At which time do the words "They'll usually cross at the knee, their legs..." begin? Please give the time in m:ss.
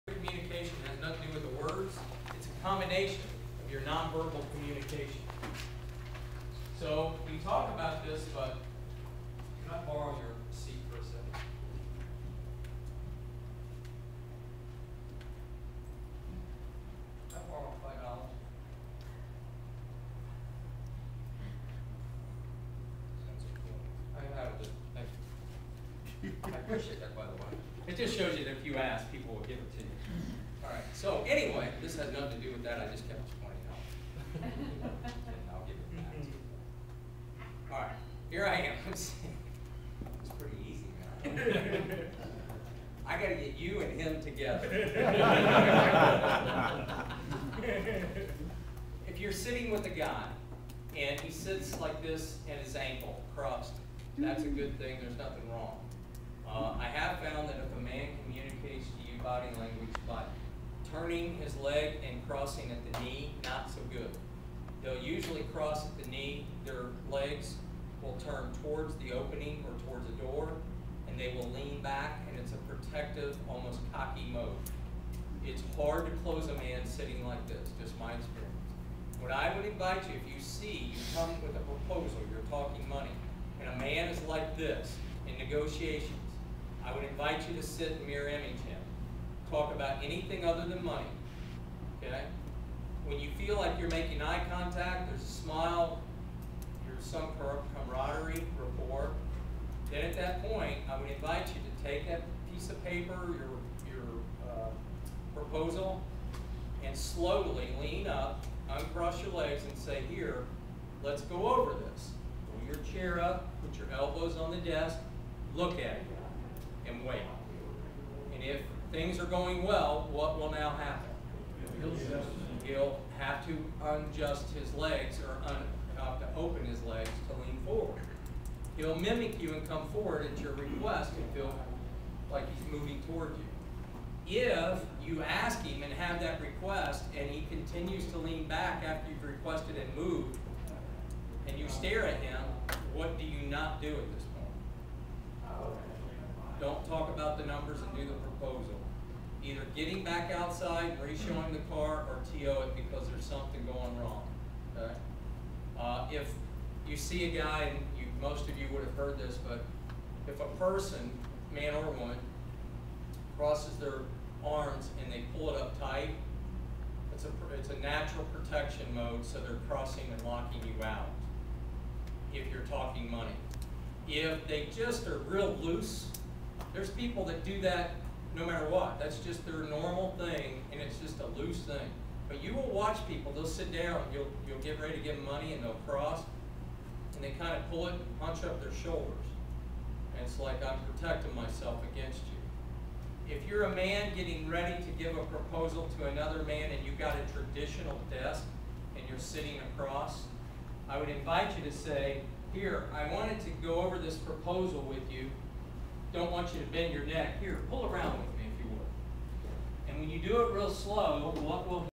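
1:04.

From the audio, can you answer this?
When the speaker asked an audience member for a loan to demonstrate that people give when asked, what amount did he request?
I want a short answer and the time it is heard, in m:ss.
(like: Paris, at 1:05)
$5, at 0:17.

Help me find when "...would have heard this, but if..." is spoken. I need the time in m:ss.
2:38.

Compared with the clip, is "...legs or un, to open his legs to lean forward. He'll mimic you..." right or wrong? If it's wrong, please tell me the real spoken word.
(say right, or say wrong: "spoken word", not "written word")
right.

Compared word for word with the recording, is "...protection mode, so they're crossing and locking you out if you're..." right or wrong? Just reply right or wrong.
right.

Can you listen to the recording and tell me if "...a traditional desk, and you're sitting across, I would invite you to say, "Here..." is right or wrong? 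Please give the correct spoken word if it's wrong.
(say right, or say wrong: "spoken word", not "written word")
right.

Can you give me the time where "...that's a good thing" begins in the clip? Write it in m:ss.
0:54.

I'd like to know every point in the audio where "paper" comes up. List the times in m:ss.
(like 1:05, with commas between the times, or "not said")
1:42.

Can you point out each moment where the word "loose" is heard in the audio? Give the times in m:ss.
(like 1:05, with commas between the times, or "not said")
2:55, 3:01.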